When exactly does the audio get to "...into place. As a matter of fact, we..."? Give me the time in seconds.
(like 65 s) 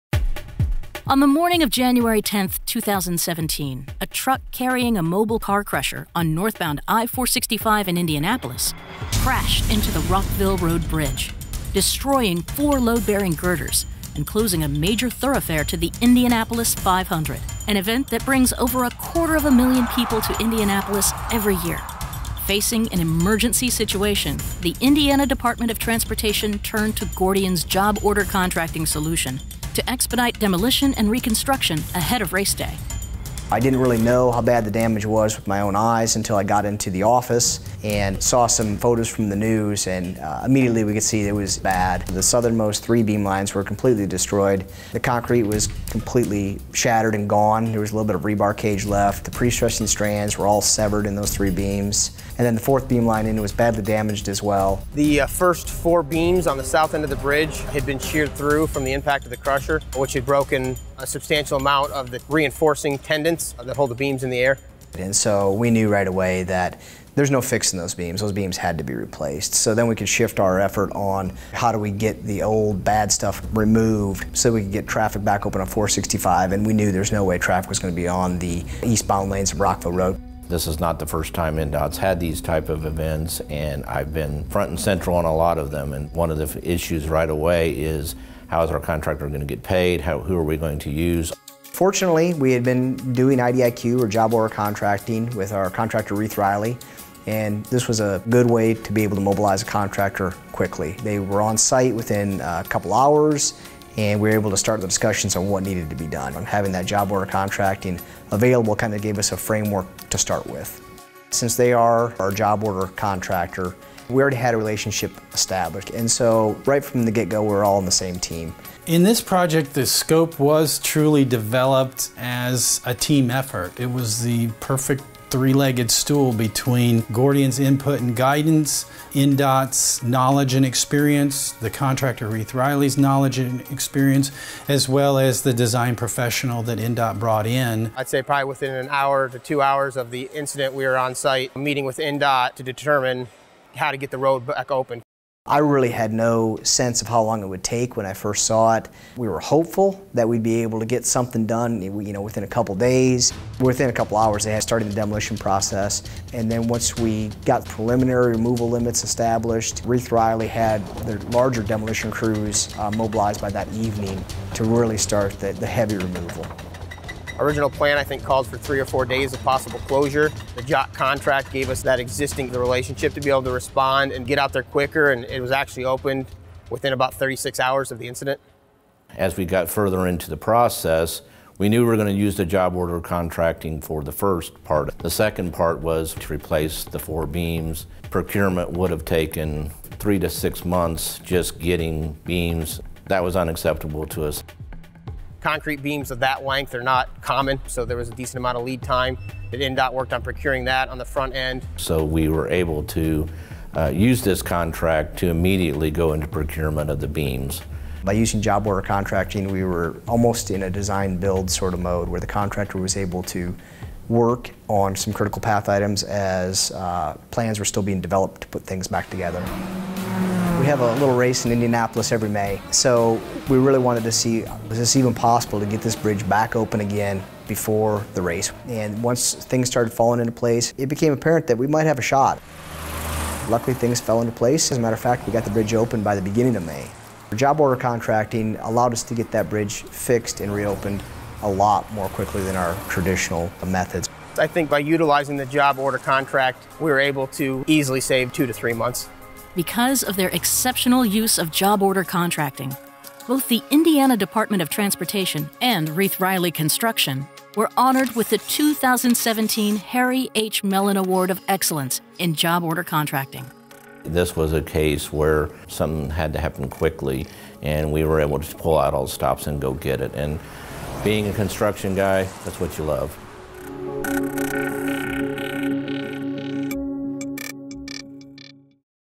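234 s.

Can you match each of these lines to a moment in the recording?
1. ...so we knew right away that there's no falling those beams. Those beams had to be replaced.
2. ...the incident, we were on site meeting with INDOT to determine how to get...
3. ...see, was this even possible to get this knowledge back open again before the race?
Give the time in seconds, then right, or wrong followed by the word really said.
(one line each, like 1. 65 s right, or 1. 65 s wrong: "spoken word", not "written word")
1. 65 s wrong: "fixing", not "falling"
2. 140 s right
3. 224 s wrong: "bridge", not "knowledge".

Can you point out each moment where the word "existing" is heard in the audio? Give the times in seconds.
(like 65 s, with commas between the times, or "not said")
171 s.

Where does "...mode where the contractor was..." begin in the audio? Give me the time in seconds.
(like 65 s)
211 s.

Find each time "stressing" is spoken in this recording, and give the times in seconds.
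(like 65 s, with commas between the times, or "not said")
49 s.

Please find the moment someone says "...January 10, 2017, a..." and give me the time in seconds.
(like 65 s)
1 s.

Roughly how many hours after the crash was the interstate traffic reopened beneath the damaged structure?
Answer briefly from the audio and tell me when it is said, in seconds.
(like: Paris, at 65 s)
36 hours, at 177 s.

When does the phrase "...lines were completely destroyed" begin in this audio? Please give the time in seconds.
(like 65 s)
43 s.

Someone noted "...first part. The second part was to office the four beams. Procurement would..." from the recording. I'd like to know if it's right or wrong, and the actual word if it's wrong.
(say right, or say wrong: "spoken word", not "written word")
wrong: "replace", not "office".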